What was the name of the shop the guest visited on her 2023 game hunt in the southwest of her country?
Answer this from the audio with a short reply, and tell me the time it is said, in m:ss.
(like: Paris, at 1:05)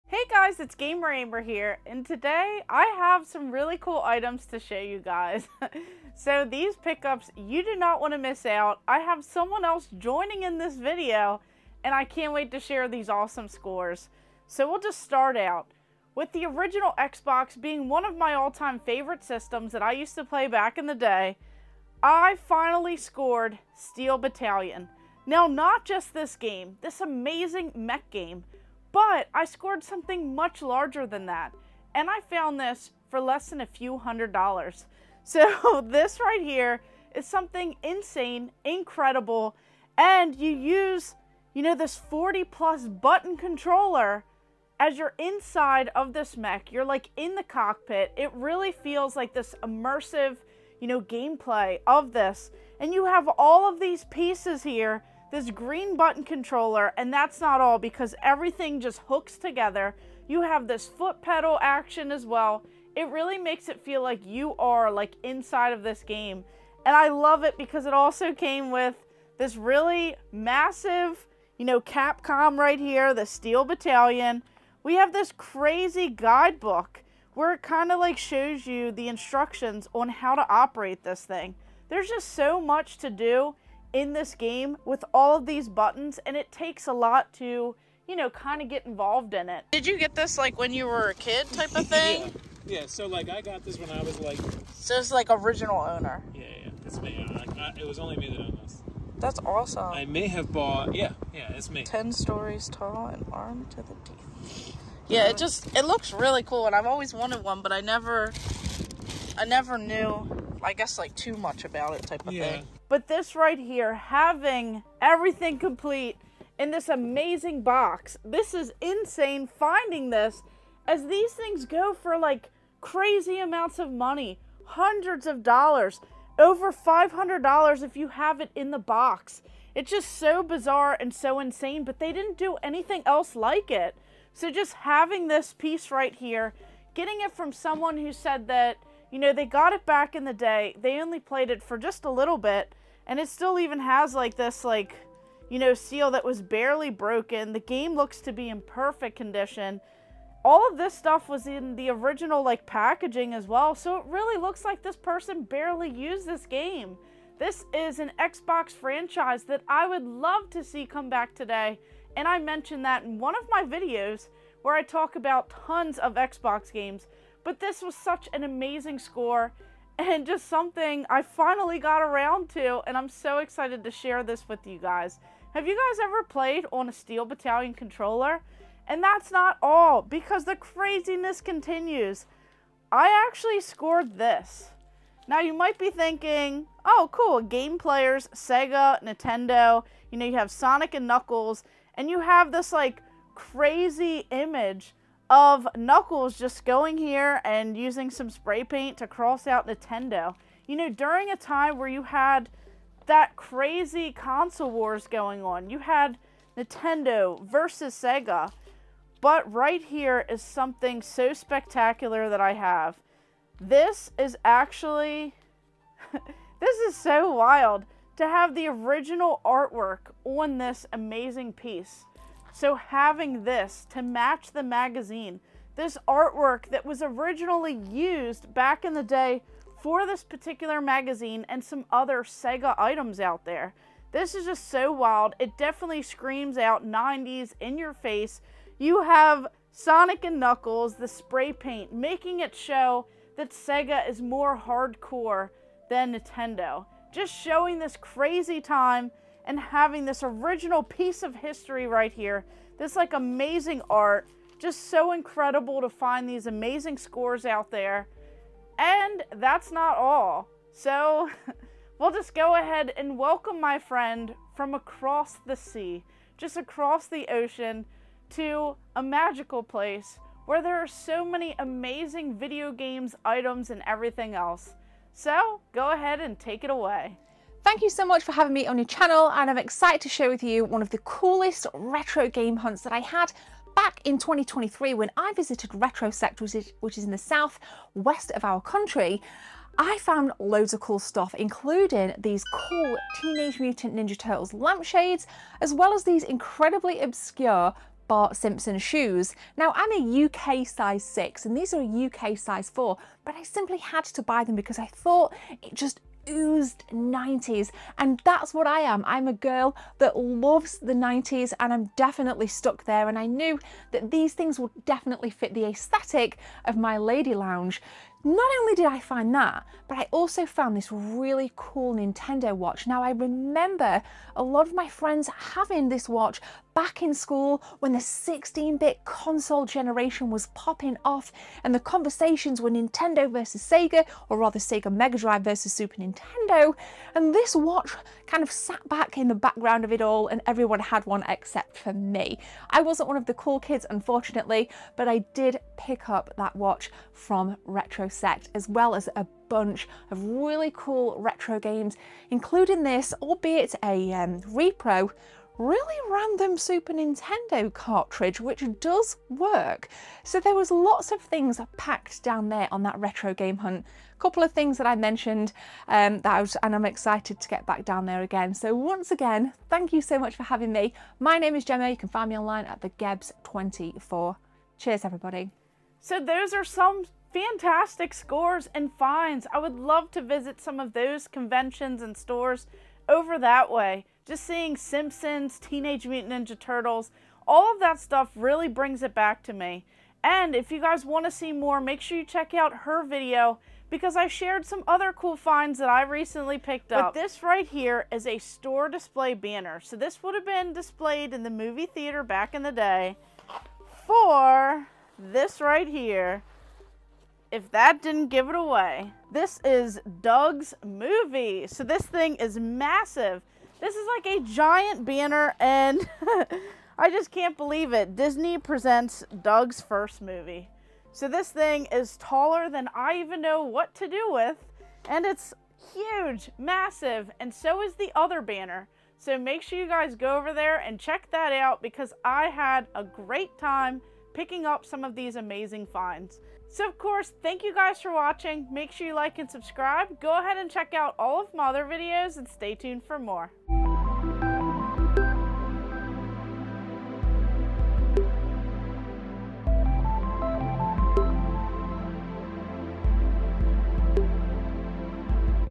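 Retro Sector, at 4:45.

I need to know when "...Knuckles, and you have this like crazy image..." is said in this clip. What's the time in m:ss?
3:11.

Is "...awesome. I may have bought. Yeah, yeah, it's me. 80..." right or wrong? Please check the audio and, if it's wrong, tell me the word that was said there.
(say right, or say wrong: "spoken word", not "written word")
wrong: "10", not "80".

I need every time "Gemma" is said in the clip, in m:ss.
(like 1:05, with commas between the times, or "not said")
6:11.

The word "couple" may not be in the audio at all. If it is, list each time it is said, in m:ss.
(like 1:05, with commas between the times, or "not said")
6:04.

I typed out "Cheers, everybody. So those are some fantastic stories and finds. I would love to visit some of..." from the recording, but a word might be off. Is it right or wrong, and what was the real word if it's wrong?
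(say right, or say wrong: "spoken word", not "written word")
wrong: "scores", not "stories".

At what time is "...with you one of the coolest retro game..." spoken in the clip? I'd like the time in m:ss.
4:40.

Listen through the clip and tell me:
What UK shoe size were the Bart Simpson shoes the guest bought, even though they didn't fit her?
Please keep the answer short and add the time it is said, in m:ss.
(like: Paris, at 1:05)
4, at 5:02.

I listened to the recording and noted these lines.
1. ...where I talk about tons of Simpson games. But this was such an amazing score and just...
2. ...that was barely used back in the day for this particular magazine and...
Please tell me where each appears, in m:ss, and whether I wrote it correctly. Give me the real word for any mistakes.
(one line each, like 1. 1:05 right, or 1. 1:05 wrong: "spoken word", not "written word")
1. 2:44 wrong: "Xbox", not "Simpson"
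2. 3:46 wrong: "originally", not "barely".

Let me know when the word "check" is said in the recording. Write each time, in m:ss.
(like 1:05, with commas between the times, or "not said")
6:32, 7:10, 7:20.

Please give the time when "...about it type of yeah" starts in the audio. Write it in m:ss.
1:51.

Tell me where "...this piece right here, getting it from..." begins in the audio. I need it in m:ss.
2:15.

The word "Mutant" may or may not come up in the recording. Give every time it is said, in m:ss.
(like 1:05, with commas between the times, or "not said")
4:53, 6:26.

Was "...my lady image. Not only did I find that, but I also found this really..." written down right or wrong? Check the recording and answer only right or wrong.
wrong.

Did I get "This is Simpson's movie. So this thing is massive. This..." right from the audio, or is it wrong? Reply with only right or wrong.
wrong.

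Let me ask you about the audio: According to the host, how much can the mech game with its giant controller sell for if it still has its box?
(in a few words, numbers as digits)
over $500.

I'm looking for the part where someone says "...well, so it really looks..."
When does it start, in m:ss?
2:33.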